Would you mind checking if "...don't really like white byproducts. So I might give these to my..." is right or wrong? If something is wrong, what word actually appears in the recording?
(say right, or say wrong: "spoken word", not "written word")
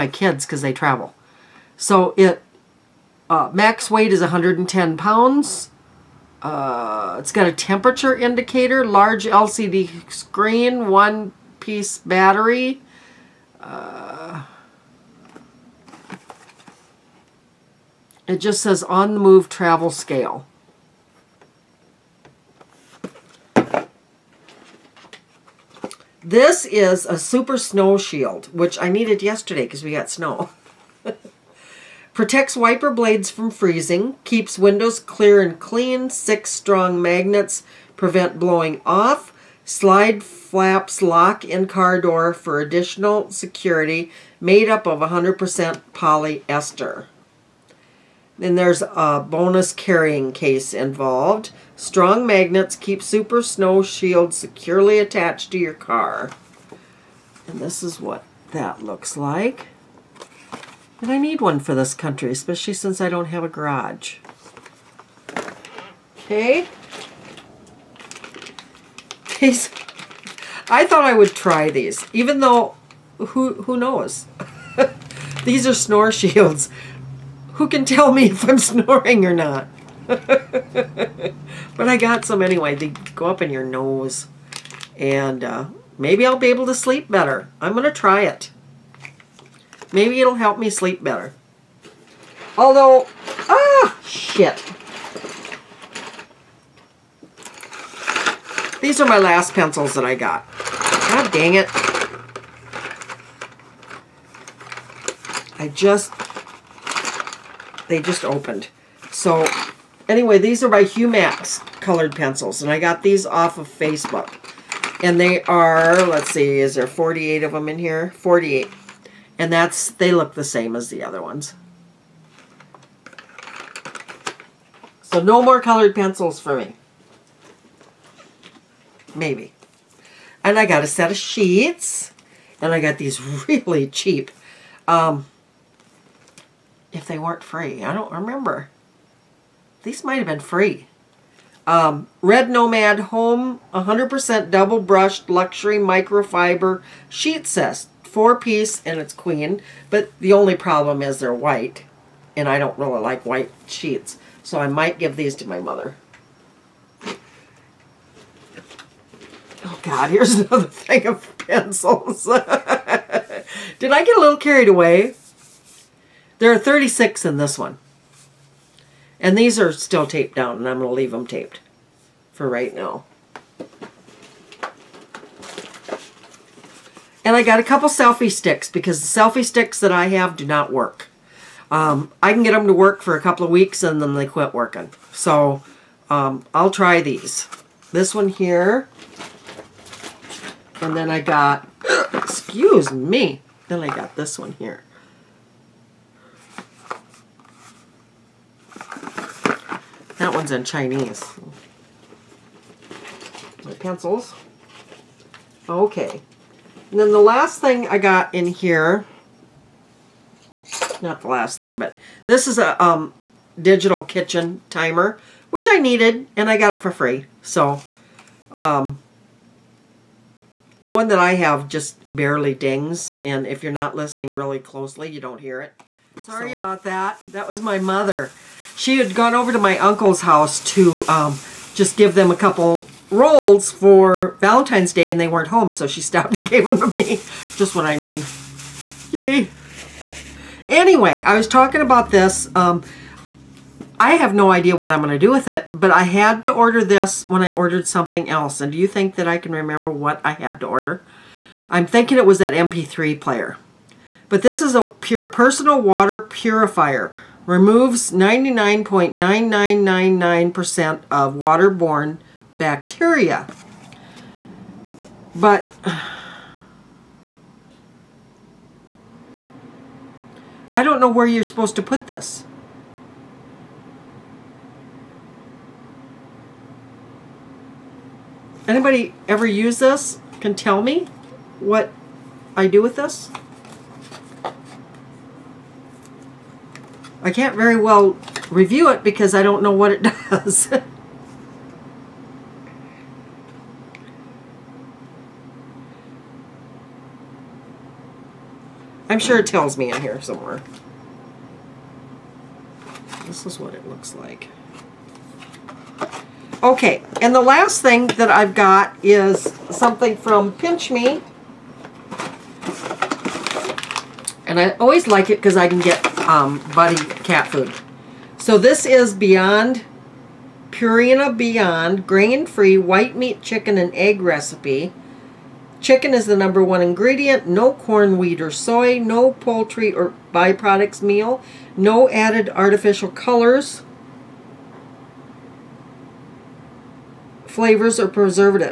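wrong: "sheets", not "byproducts".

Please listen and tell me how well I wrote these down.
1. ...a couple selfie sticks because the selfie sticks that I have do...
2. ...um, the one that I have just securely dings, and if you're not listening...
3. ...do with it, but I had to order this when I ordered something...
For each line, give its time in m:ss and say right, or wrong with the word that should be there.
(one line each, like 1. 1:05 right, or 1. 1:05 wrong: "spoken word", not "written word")
1. 2:57 right
2. 3:38 wrong: "barely", not "securely"
3. 4:05 right.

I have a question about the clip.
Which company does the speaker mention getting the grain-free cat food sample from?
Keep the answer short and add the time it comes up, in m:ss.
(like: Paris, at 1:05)
Pinch Me, at 5:10.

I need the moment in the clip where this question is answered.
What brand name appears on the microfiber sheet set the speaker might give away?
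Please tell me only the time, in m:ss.
2:22.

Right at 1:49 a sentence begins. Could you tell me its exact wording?
So anyway, these are by Humax colored pencils, and I got these off of Facebook.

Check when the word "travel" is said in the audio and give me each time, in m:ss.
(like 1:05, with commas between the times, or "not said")
0:00, 0:19.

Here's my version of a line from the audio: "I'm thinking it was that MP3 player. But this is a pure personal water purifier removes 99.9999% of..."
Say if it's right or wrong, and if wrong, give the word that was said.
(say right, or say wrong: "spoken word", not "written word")
right.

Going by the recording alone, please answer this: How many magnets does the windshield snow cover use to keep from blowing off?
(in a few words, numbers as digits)
6.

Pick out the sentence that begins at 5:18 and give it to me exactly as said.
So this is Beyond Purina Beyond grain-free white meat chicken and egg recipe.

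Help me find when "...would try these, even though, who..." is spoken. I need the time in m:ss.
1:11.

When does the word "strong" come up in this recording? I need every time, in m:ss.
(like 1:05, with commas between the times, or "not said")
0:36, 0:51.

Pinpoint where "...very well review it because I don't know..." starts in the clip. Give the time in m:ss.
4:47.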